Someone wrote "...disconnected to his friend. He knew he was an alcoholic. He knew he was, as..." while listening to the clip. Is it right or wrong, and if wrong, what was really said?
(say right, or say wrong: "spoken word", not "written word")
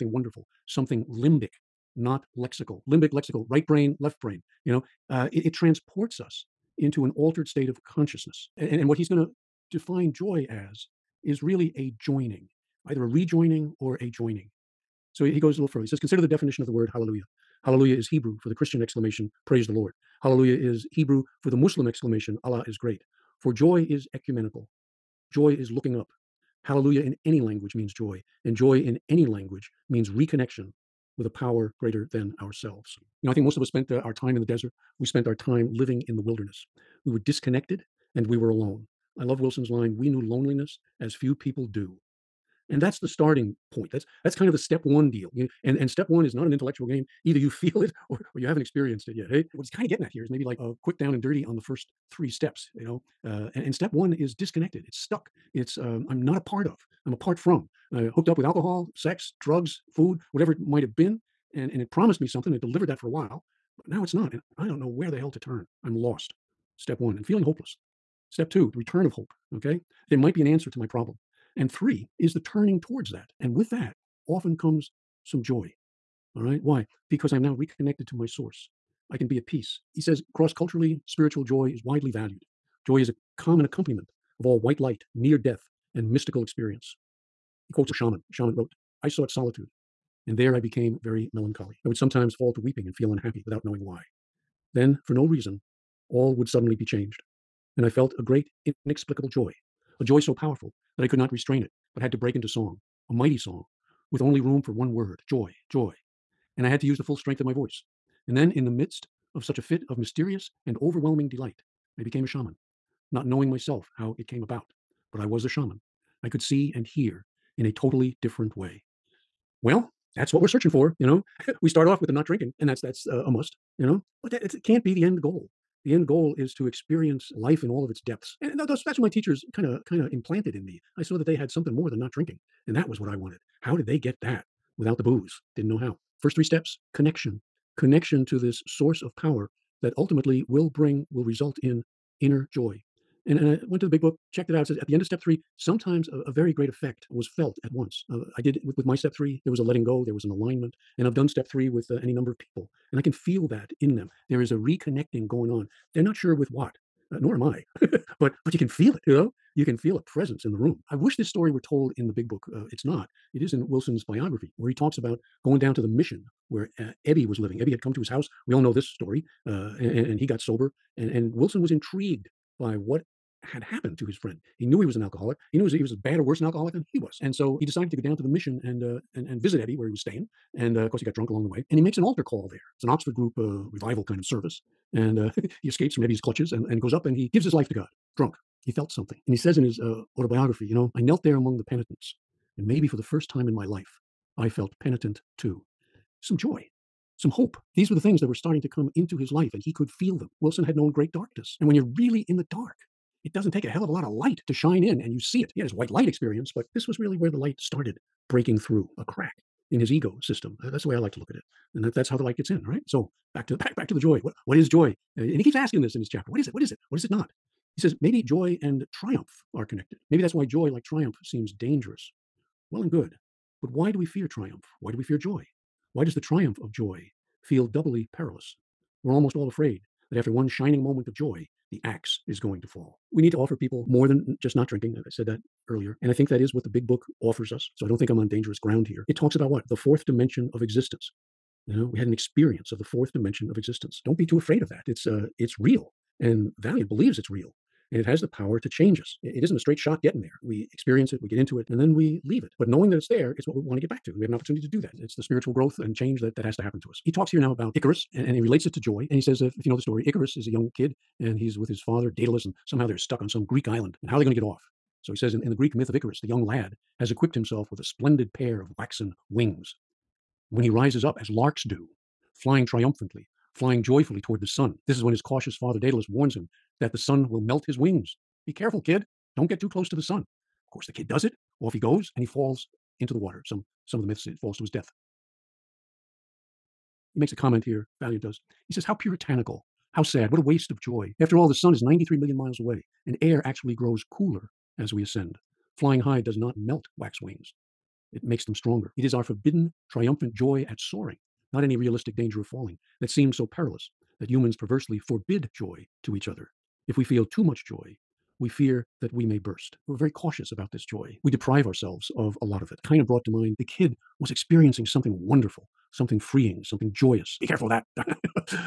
wrong: "happened", not "disconnected".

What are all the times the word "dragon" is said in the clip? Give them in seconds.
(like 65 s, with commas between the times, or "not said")
not said.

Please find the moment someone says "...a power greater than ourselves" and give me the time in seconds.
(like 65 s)
31 s.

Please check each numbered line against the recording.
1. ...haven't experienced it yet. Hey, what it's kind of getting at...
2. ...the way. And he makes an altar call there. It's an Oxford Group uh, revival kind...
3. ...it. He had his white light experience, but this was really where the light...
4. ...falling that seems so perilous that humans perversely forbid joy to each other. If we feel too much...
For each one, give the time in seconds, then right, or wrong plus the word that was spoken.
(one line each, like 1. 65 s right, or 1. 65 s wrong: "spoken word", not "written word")
1. 48 s right
2. 181 s right
3. 205 s right
4. 302 s right.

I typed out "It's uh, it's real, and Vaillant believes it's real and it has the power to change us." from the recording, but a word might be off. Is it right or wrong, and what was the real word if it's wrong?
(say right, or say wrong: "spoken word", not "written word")
right.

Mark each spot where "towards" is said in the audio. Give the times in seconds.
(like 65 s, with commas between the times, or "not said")
72 s, 274 s.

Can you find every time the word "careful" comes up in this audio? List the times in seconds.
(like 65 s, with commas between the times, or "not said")
278 s, 317 s.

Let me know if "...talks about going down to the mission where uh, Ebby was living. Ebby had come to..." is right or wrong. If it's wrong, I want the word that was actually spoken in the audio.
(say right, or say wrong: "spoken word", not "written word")
right.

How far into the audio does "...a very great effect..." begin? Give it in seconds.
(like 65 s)
146 s.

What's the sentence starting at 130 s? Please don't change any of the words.
I saw that they had something more than not drinking, and that was what I wanted.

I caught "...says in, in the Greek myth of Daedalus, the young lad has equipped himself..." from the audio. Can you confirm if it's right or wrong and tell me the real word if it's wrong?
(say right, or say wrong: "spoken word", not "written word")
wrong: "Icarus", not "Daedalus".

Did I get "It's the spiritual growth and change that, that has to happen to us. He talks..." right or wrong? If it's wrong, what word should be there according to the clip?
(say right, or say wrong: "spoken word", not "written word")
right.